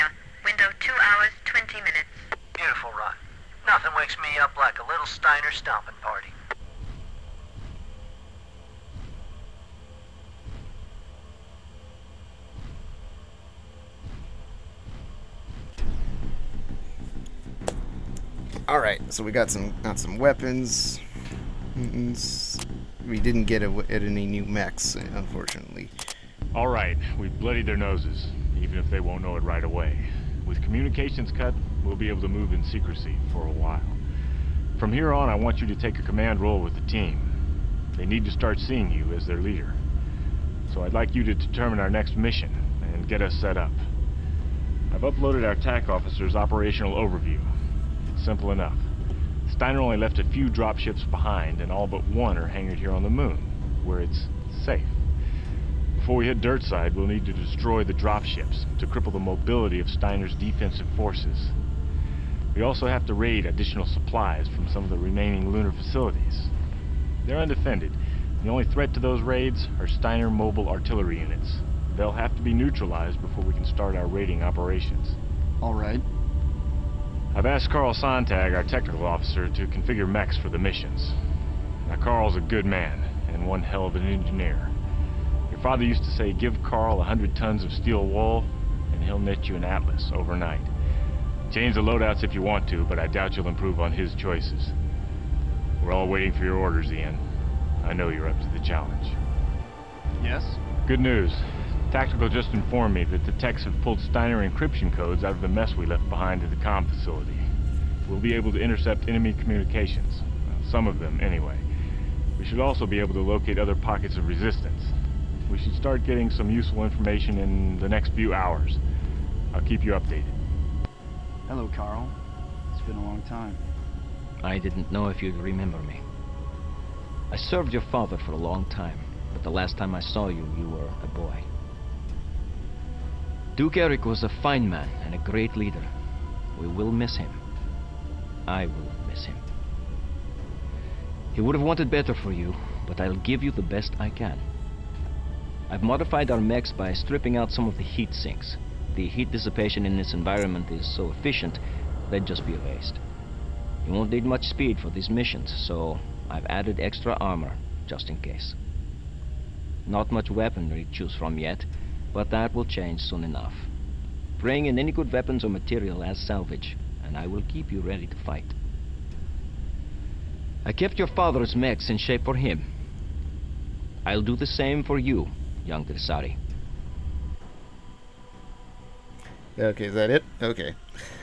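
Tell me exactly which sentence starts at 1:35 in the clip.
We're all waiting for your orders, Ian.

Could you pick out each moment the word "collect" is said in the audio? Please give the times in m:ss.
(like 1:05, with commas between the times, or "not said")
not said.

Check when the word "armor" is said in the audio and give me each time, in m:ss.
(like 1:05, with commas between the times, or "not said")
2:37.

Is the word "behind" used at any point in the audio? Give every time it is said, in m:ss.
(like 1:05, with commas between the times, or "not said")
0:51, 1:46.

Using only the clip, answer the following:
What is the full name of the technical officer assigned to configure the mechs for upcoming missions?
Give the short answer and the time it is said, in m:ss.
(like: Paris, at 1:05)
Carl Sontag, at 1:17.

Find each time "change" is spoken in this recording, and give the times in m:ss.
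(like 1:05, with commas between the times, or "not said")
1:31, 2:42.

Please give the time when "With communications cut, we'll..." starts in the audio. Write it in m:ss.
0:30.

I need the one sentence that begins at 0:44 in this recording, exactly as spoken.
I've uploaded our TAC officer's operational overview.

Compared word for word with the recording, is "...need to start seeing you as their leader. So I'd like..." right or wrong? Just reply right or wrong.
right.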